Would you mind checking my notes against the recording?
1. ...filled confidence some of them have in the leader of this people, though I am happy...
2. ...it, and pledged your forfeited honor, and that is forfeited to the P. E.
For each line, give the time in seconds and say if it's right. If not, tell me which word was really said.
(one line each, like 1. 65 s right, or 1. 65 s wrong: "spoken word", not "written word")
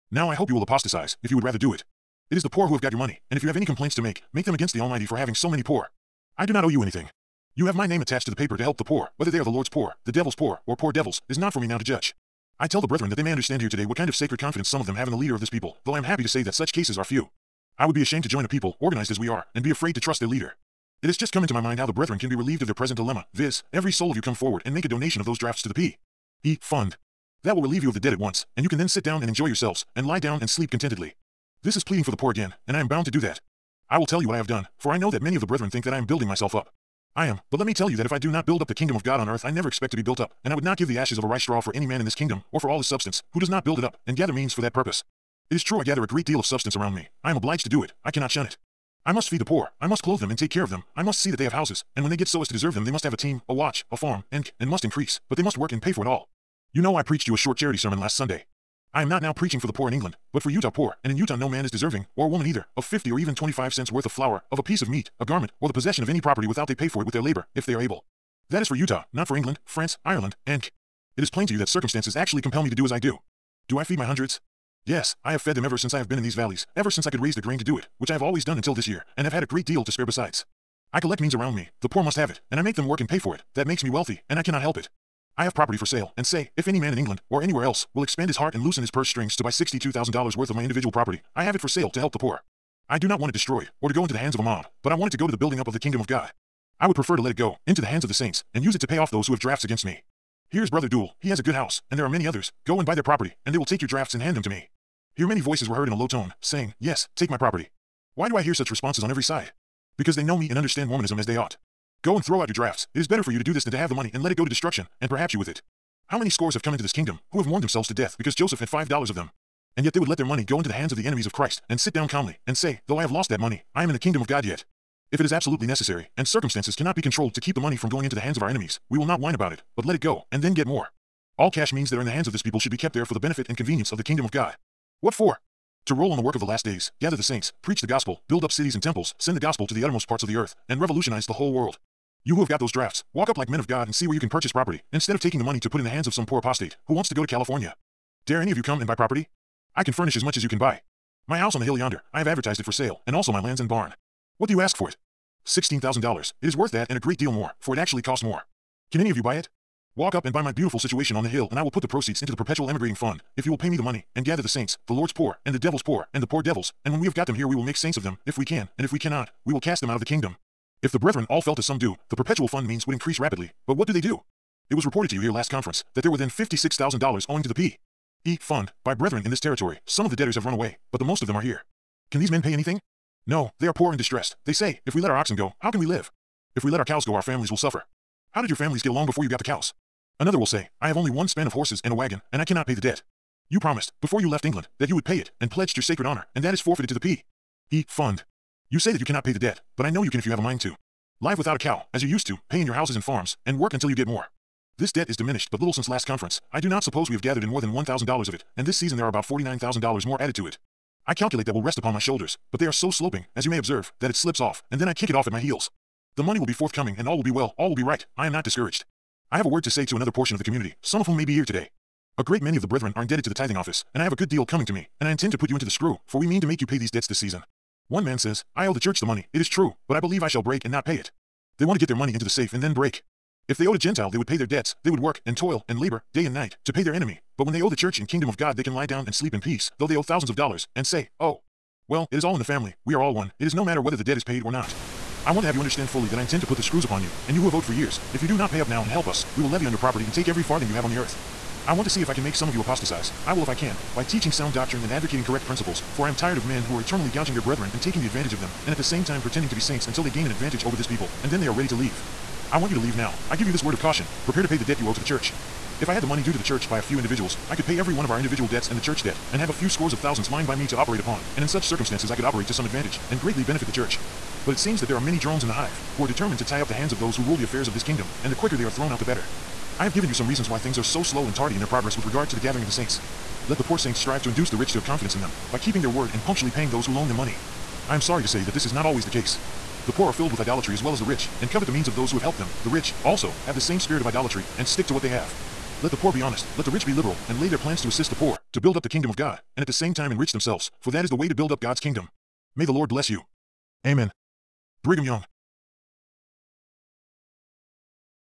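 1. 14 s wrong: "sacred", not "filled"
2. 195 s wrong: "sacred", not "forfeited".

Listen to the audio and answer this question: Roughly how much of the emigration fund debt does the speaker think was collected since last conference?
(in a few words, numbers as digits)
$1,000.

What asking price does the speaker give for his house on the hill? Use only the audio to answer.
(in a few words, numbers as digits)
$16,000.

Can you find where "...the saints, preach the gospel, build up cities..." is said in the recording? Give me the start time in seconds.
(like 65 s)
137 s.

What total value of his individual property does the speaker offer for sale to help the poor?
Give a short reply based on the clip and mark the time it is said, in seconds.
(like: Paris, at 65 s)
$62,000, at 89 s.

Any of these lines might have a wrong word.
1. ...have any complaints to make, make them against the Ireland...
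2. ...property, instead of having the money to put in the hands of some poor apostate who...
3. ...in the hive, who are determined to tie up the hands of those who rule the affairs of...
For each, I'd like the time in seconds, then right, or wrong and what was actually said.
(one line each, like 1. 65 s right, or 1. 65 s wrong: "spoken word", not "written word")
1. 3 s wrong: "Almighty", not "Ireland"
2. 144 s wrong: "taking", not "having"
3. 275 s right.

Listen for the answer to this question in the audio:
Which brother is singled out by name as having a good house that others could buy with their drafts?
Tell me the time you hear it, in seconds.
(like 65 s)
100 s.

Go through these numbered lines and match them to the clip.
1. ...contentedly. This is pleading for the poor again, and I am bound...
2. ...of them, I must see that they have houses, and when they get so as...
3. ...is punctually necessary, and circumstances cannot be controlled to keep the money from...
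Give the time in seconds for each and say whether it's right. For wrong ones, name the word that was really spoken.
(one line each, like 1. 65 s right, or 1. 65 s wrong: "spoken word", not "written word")
1. 30 s right
2. 50 s right
3. 125 s wrong: "absolutely", not "punctually".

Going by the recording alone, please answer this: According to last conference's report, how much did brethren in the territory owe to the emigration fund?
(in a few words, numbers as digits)
$56,000.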